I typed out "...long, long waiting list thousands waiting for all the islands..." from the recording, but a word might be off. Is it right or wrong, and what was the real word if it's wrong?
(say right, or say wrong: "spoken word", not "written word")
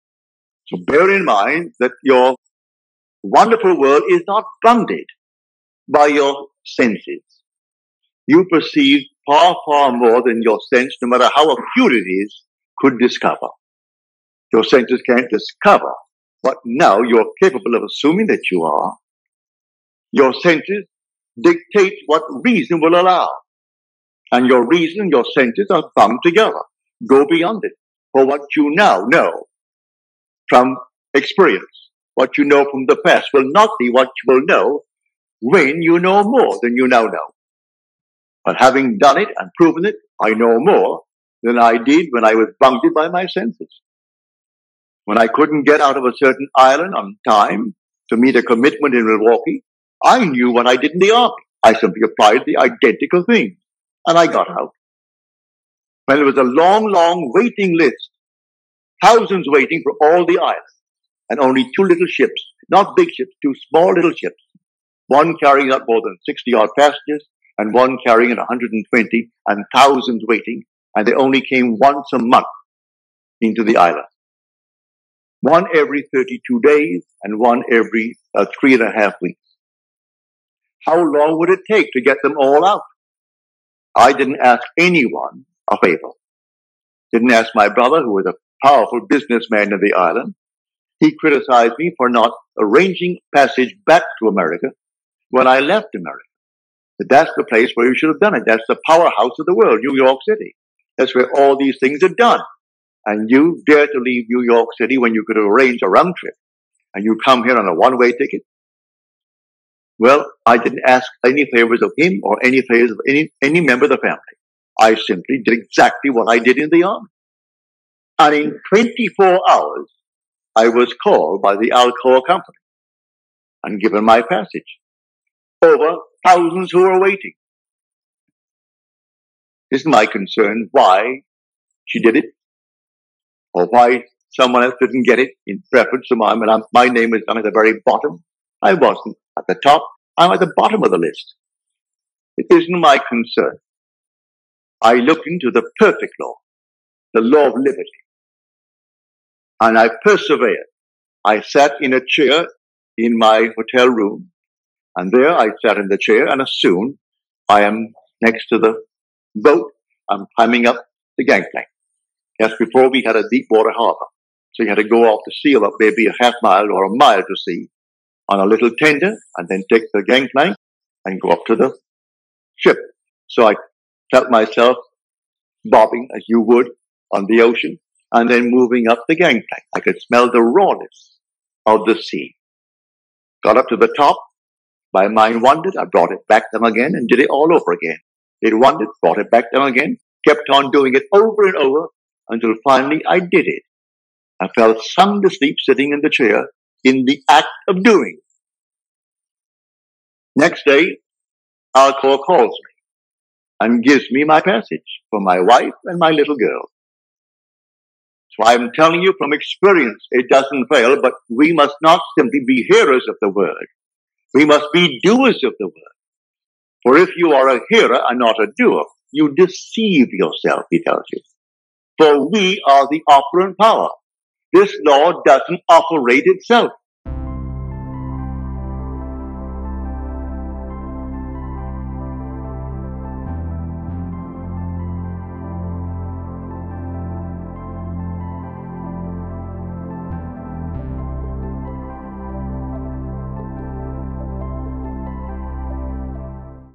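right.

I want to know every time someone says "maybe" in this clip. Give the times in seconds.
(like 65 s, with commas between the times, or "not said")
165 s.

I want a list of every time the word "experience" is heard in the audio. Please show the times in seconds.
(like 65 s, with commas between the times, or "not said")
31 s, 209 s.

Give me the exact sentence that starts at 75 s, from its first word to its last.
One every 32 days, and one every uh, three and a half weeks.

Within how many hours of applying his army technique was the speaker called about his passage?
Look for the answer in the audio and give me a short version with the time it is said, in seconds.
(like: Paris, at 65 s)
24, at 118 s.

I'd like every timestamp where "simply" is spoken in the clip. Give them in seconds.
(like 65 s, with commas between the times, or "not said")
51 s, 114 s, 212 s.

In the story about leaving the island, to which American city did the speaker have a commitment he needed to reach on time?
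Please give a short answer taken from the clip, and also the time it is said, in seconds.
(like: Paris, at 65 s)
Milwaukee, at 49 s.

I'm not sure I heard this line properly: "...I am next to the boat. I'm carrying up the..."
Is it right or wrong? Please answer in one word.
wrong.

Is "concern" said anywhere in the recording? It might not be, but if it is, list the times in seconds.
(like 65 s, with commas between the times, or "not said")
130 s, 143 s.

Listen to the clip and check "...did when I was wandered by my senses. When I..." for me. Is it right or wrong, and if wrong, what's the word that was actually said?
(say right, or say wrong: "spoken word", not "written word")
wrong: "bounded", not "wandered".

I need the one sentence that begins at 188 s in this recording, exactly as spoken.
It wandered, brought it back them again, kept on doing it over and over until finally I did it.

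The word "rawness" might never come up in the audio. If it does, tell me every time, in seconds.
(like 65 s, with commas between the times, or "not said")
180 s.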